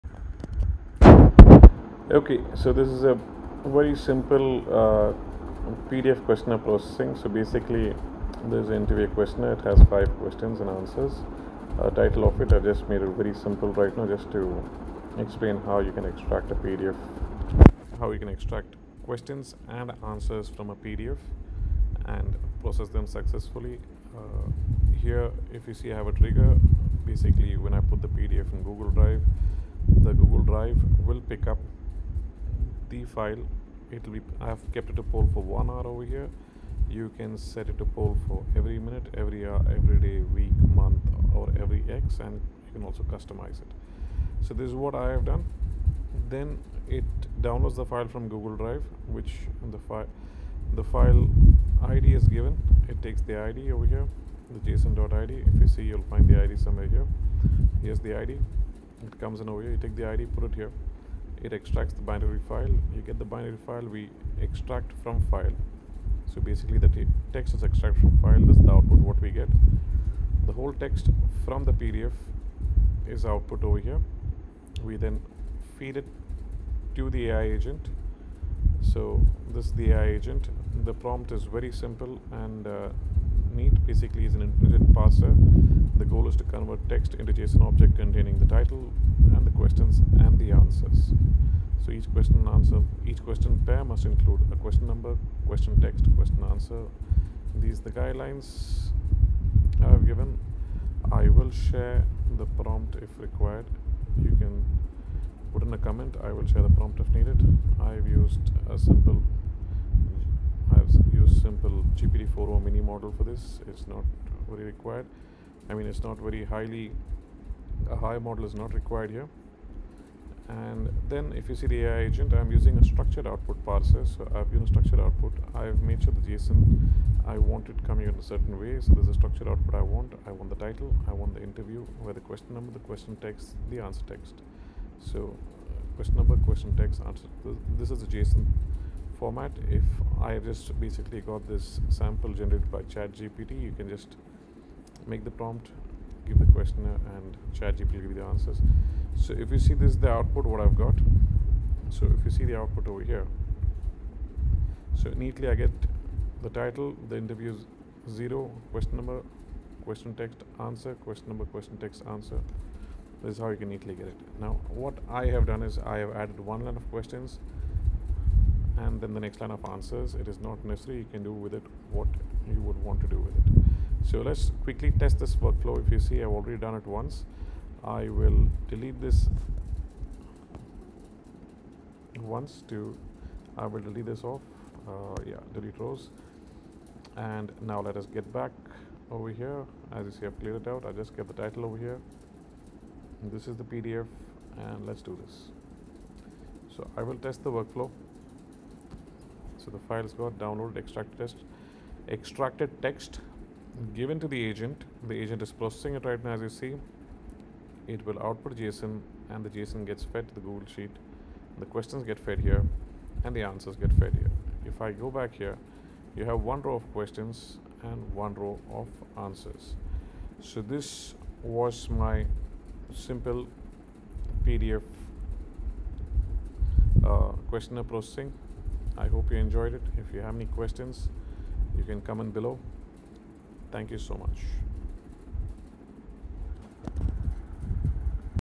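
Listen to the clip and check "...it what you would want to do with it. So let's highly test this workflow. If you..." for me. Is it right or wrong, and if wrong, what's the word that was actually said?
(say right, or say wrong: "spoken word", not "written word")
wrong: "quickly", not "highly".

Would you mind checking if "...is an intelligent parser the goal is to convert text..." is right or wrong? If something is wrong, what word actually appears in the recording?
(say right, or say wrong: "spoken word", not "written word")
right.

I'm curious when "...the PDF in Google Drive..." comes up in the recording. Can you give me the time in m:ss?
0:28.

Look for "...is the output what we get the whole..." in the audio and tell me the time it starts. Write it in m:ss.
1:08.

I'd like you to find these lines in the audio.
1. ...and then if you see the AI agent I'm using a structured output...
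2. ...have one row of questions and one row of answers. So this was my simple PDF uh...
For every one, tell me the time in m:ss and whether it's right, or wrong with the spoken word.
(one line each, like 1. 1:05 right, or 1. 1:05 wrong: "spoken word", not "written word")
1. 2:00 right
2. 3:36 right.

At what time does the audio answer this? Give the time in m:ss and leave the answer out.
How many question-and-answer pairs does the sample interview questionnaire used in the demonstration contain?
0:09.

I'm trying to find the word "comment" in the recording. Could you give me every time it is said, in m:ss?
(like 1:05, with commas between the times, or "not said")
1:45, 3:52.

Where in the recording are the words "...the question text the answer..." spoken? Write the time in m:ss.
2:12.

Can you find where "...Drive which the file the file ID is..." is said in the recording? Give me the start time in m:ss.
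0:48.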